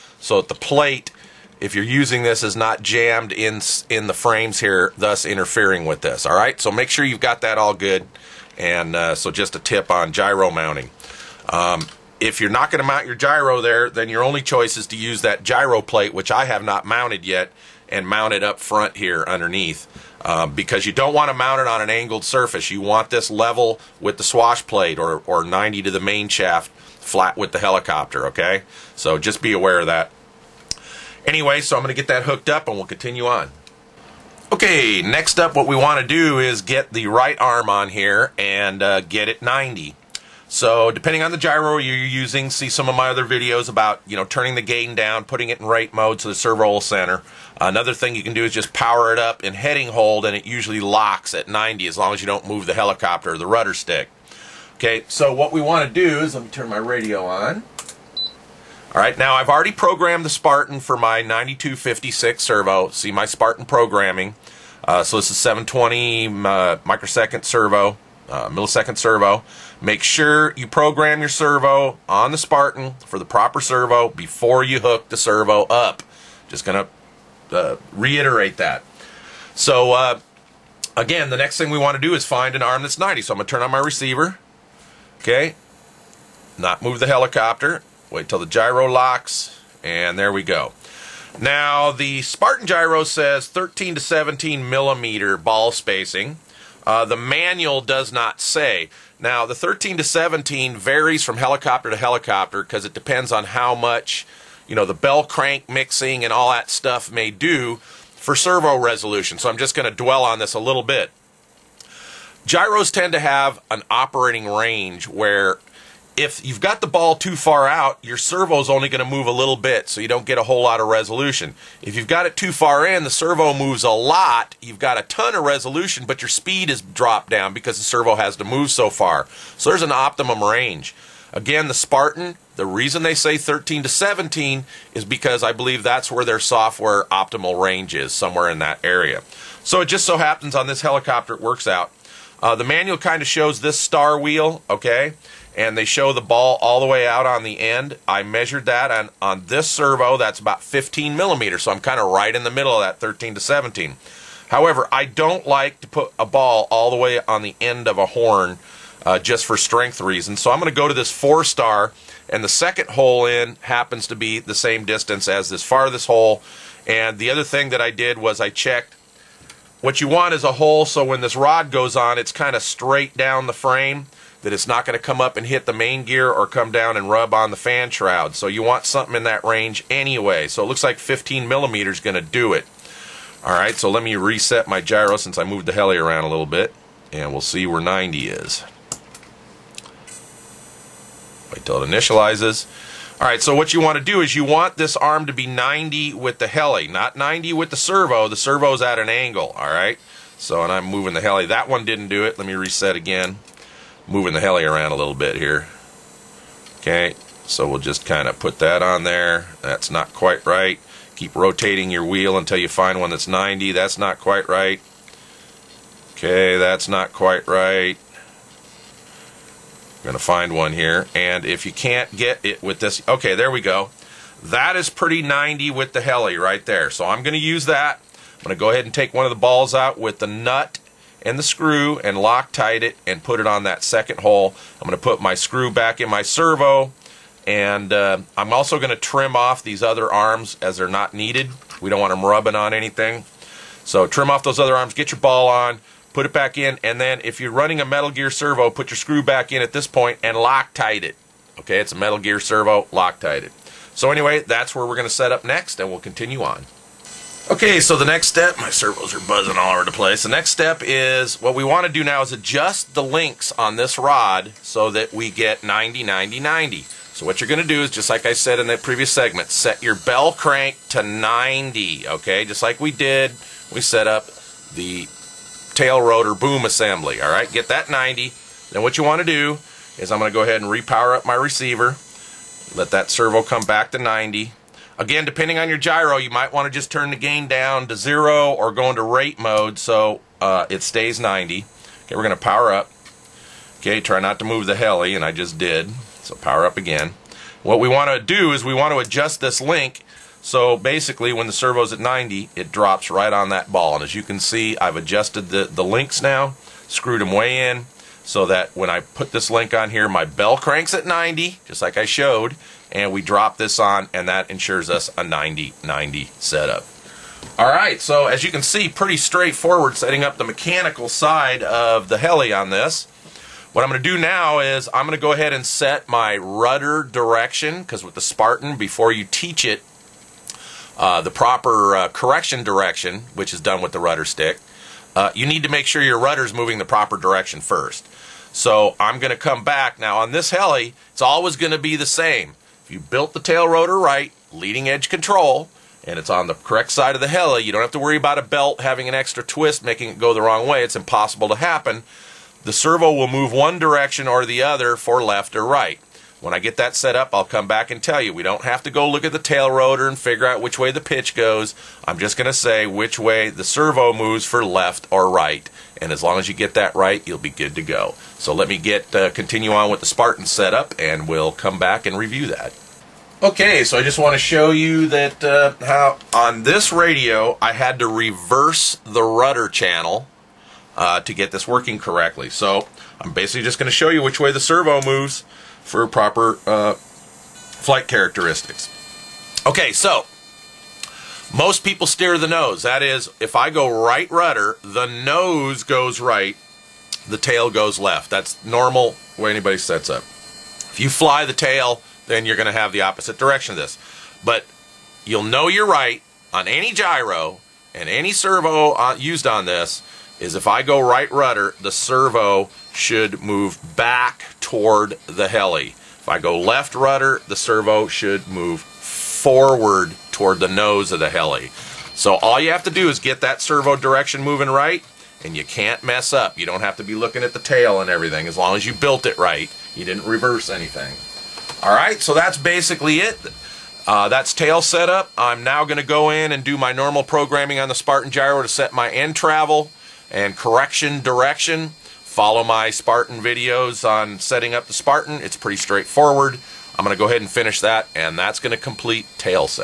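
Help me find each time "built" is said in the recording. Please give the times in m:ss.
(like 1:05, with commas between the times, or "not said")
5:42, 7:08.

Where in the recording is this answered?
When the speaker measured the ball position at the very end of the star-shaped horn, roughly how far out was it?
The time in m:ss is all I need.
2:30.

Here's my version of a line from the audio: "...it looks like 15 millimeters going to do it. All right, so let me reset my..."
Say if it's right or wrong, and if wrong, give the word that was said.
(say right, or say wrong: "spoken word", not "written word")
right.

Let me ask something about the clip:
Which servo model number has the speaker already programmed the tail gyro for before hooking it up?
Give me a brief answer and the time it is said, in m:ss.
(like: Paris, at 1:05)
9256, at 1:01.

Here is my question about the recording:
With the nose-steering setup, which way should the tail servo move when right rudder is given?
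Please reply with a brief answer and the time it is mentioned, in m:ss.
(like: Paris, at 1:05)
back toward the heli, at 6:53.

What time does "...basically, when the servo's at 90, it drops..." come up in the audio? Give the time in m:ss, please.
5:00.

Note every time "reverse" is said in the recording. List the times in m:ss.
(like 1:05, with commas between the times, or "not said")
6:18, 7:10.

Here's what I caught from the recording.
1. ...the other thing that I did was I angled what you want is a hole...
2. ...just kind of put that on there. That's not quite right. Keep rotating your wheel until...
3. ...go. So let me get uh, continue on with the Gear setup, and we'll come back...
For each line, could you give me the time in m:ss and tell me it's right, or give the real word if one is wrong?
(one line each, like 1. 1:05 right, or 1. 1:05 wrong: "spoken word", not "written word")
1. 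2:47 wrong: "checked", not "angled"
2. 3:27 right
3. 6:07 wrong: "Spartan", not "Gear".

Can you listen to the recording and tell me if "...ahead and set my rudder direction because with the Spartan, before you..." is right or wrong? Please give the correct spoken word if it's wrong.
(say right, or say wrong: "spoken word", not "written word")
right.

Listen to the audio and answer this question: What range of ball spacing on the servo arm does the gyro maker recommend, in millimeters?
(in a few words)
13 to 17.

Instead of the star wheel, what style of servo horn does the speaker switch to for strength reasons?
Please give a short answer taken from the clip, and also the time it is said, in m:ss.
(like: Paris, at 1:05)
four-star, at 2:41.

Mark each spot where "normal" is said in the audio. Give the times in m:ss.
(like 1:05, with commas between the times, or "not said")
6:38, 7:16.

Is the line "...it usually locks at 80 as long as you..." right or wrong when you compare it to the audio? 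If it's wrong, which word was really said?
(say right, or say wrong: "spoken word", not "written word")
wrong: "90", not "80".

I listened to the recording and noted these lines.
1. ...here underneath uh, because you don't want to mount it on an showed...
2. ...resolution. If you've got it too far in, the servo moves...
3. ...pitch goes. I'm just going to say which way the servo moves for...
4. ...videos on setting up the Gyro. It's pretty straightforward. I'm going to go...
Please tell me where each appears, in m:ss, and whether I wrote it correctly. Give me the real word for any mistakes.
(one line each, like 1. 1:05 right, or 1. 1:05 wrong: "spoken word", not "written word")
1. 0:18 wrong: "angled", not "showed"
2. 2:00 right
3. 6:01 right
4. 7:23 wrong: "Spartan", not "Gyro".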